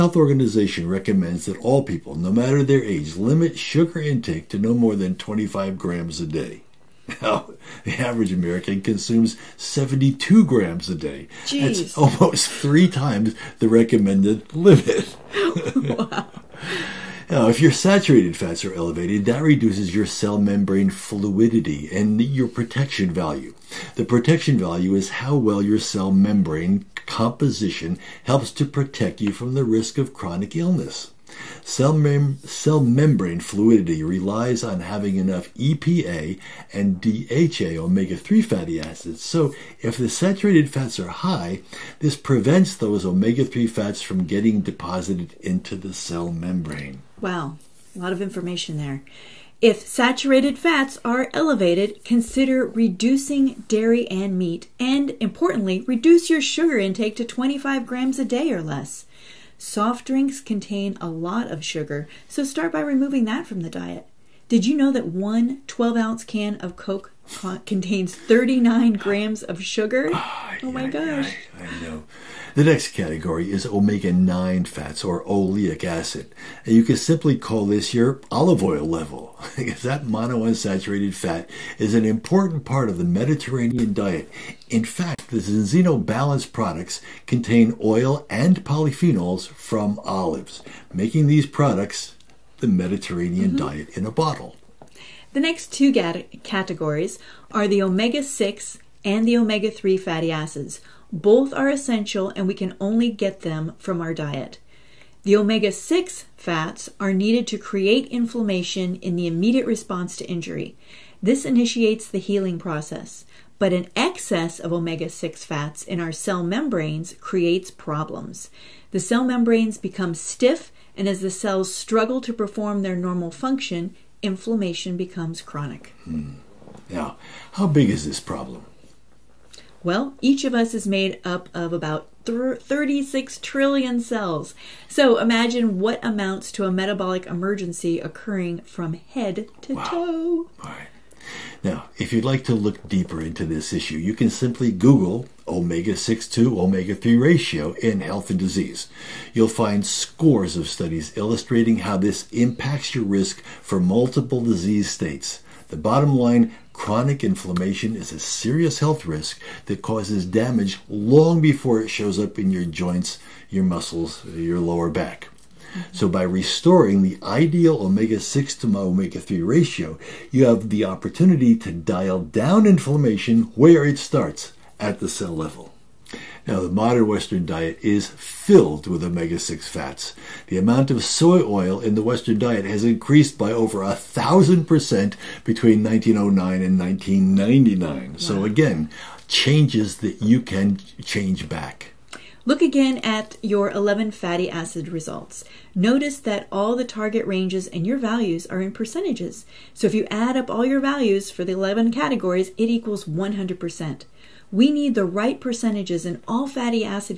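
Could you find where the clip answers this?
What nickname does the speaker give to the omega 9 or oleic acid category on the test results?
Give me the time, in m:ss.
1:18.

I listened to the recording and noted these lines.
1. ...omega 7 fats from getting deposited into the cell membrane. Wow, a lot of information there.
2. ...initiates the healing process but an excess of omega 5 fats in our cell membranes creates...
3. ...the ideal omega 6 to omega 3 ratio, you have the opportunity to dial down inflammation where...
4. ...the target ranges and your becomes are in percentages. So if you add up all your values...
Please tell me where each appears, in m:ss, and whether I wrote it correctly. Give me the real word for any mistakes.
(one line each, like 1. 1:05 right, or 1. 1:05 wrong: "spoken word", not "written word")
1. 0:43 wrong: "3", not "7"
2. 1:51 wrong: "6", not "5"
3. 2:47 right
4. 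3:16 wrong: "values", not "becomes".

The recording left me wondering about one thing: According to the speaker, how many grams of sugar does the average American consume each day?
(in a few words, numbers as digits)
72 grams.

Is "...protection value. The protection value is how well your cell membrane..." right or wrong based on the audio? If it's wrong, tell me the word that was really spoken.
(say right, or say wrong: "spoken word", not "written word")
right.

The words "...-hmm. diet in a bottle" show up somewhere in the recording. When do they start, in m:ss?
1:33.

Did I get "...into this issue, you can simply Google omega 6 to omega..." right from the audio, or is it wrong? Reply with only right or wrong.
right.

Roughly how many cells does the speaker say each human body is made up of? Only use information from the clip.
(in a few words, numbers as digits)
36 trillion.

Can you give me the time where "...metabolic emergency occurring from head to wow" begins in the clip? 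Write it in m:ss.
2:16.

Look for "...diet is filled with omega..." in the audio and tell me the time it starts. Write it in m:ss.
2:57.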